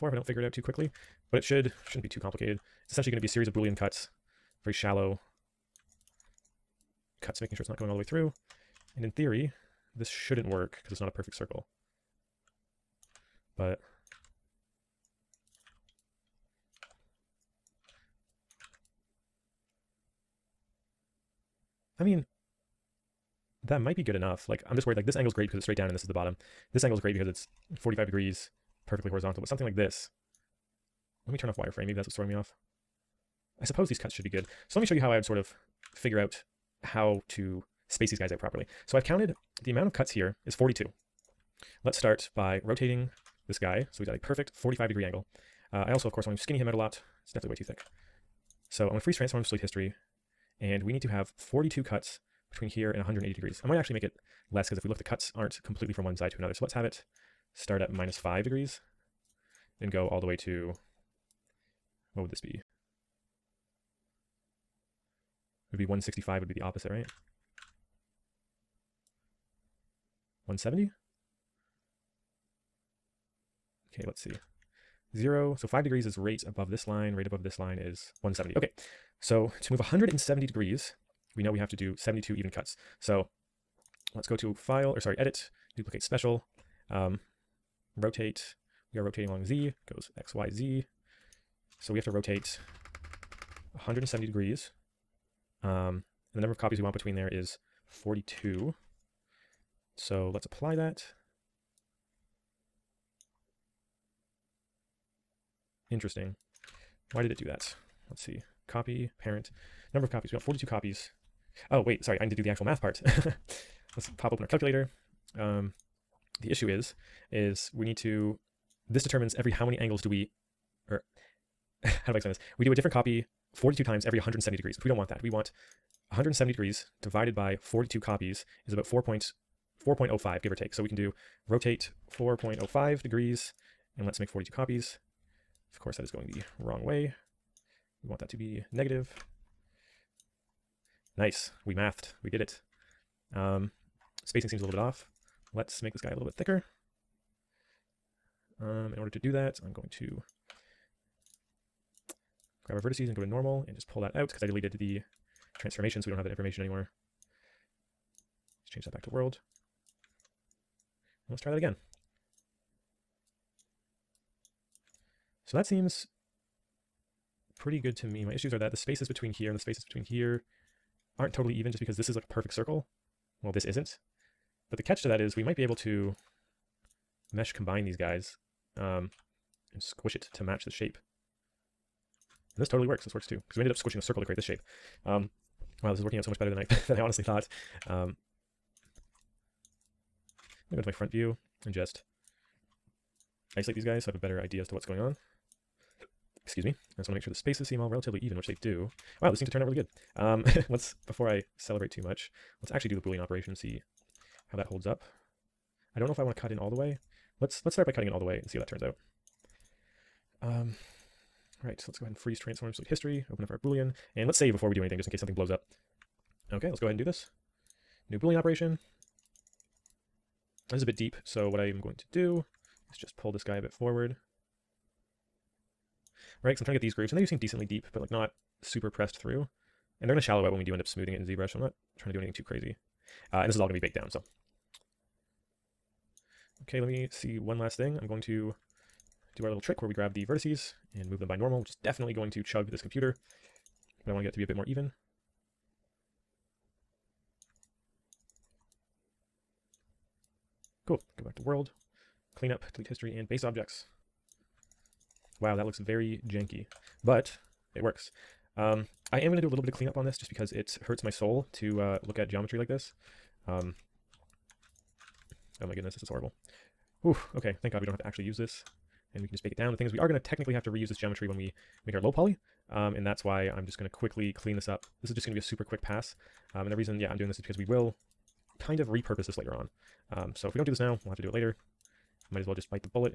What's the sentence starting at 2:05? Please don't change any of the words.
We want 170 degrees divided by 42 copies is about 4.05, give or take.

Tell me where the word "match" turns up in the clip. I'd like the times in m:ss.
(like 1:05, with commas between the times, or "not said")
3:00.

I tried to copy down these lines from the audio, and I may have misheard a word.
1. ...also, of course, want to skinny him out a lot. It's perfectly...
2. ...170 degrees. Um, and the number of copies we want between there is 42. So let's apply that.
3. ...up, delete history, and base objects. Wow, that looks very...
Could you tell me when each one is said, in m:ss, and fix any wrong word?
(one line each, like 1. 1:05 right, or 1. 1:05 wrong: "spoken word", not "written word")
1. 0:45 wrong: "definitely", not "perfectly"
2. 1:33 right
3. 4:12 right.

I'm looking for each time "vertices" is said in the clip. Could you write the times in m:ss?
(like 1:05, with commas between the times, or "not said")
2:32, 4:00.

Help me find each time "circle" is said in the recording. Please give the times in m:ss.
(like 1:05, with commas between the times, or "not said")
0:11, 2:52, 3:04.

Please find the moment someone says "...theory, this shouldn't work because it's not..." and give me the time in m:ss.
0:09.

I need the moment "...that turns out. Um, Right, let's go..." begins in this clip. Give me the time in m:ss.
3:28.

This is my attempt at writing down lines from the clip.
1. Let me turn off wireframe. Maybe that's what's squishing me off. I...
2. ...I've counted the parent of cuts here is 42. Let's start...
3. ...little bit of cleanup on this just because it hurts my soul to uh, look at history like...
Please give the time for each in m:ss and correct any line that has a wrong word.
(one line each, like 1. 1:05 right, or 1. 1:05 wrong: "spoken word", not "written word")
1. 0:31 wrong: "throwing", not "squishing"
2. 0:38 wrong: "amount", not "parent"
3. 4:19 wrong: "geometry", not "history".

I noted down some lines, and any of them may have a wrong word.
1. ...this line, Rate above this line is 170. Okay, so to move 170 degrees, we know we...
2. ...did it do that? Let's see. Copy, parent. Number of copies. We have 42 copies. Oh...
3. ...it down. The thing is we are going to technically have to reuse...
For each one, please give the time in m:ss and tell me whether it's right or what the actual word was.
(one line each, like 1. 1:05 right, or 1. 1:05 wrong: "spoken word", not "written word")
1. 1:16 right
2. 1:47 right
3. 4:29 right.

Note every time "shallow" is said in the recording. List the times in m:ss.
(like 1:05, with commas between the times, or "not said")
0:04, 3:50.